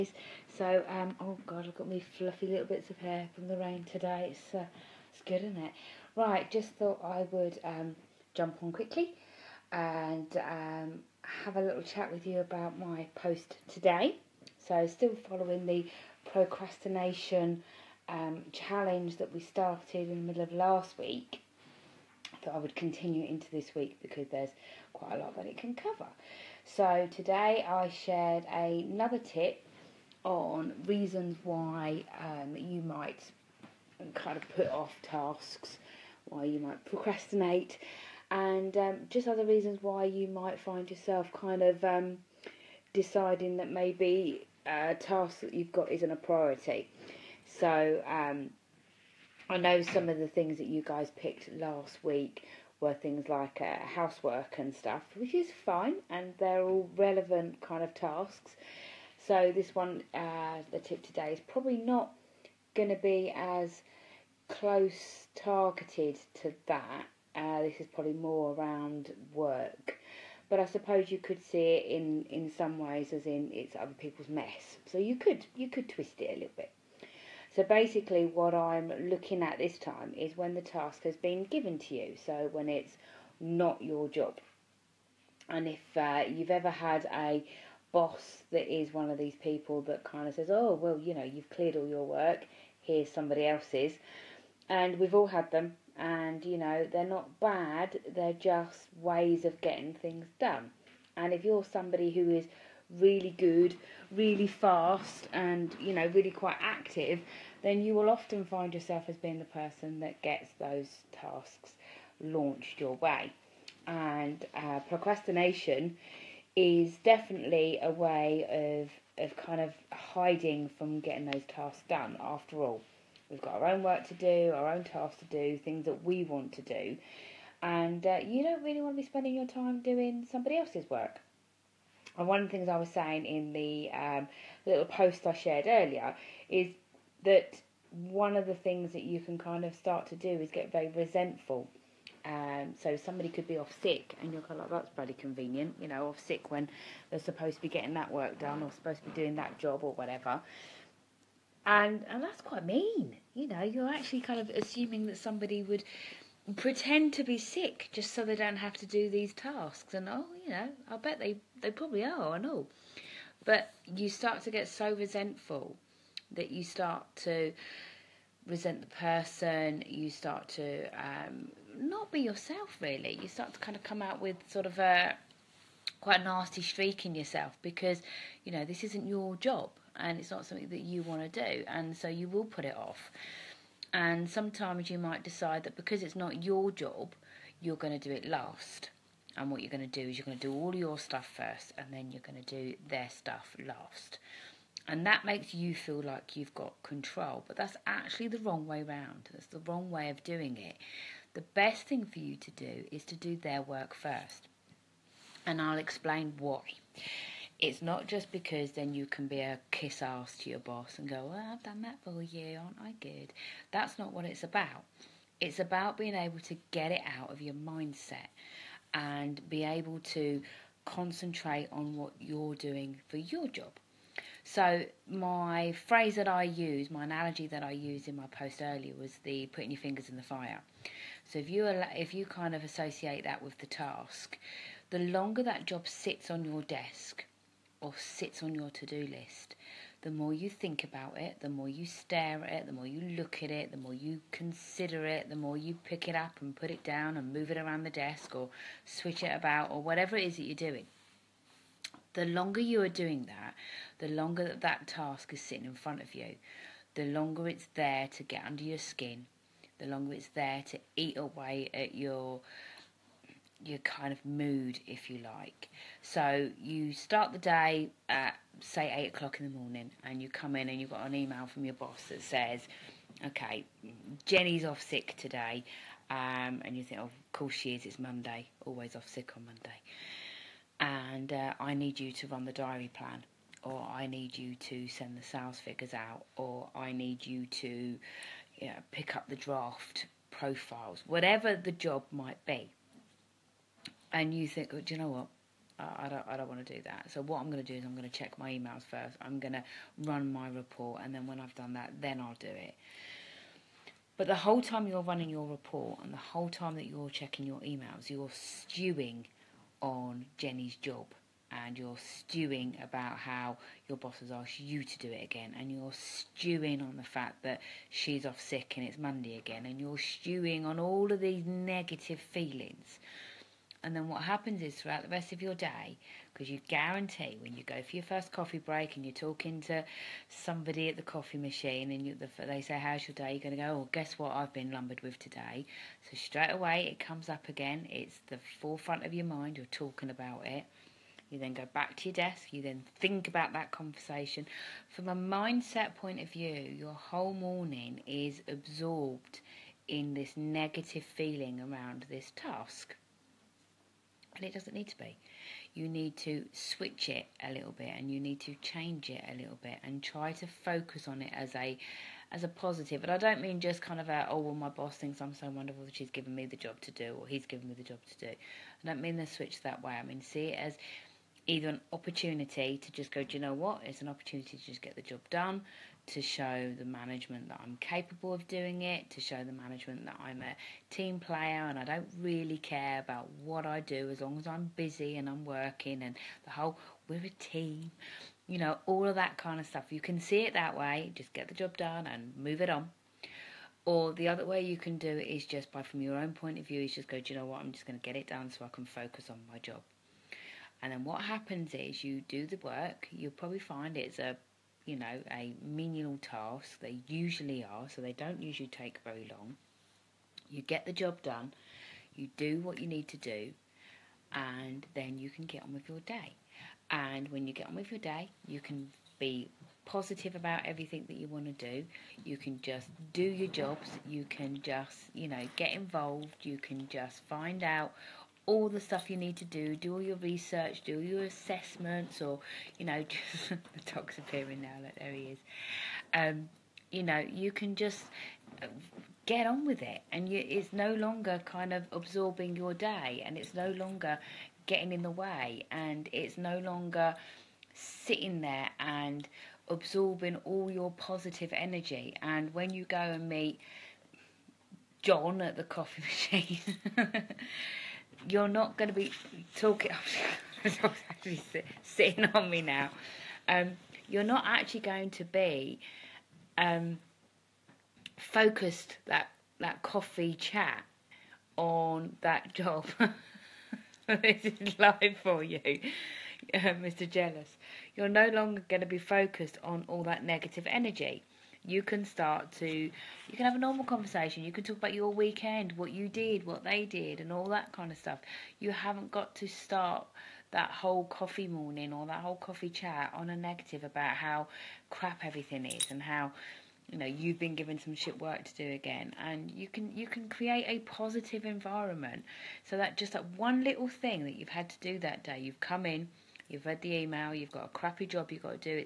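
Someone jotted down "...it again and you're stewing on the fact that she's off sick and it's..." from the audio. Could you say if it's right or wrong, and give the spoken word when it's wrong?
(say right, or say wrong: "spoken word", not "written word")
right.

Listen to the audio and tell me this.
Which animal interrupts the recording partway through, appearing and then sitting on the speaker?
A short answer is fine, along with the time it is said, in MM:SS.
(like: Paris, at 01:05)
dog, at 07:13.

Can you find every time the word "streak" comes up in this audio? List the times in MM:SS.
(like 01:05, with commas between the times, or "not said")
02:56.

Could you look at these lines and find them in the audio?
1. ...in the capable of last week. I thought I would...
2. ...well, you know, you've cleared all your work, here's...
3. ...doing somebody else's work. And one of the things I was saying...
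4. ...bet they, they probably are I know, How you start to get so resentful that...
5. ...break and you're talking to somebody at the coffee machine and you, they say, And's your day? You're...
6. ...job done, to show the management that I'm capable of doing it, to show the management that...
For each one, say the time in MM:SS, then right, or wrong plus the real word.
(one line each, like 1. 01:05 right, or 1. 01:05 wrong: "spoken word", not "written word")
1. 00:20 wrong: "middle", not "capable"
2. 01:30 right
3. 02:09 right
4. 02:40 wrong: "But", not "How"
5. 05:28 wrong: "How", not "And"
6. 06:15 right.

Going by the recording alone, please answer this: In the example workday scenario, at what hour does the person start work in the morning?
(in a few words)
8 o'clock.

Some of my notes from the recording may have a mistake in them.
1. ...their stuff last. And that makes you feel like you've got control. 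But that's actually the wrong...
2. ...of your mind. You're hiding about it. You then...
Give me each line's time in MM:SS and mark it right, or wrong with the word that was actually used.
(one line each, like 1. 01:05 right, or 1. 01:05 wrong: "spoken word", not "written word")
1. 03:12 right
2. 05:39 wrong: "talking", not "hiding".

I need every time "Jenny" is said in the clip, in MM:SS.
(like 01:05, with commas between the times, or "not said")
04:34, 05:10.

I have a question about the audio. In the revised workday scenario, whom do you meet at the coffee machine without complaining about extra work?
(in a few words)
John.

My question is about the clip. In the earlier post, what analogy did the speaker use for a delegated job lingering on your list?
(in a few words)
putting your fingers in the fire.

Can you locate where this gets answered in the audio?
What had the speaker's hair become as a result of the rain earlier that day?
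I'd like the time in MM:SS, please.
00:01.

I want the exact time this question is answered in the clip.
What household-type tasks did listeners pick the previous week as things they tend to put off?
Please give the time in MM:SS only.
00:53.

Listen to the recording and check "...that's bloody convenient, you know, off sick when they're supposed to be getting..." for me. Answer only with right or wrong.
right.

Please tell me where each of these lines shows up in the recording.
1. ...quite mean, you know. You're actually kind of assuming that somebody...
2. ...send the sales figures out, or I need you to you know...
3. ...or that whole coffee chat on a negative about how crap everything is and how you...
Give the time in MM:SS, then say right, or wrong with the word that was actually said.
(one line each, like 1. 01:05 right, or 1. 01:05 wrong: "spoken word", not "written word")
1. 02:32 right
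2. 04:44 right
3. 08:11 right.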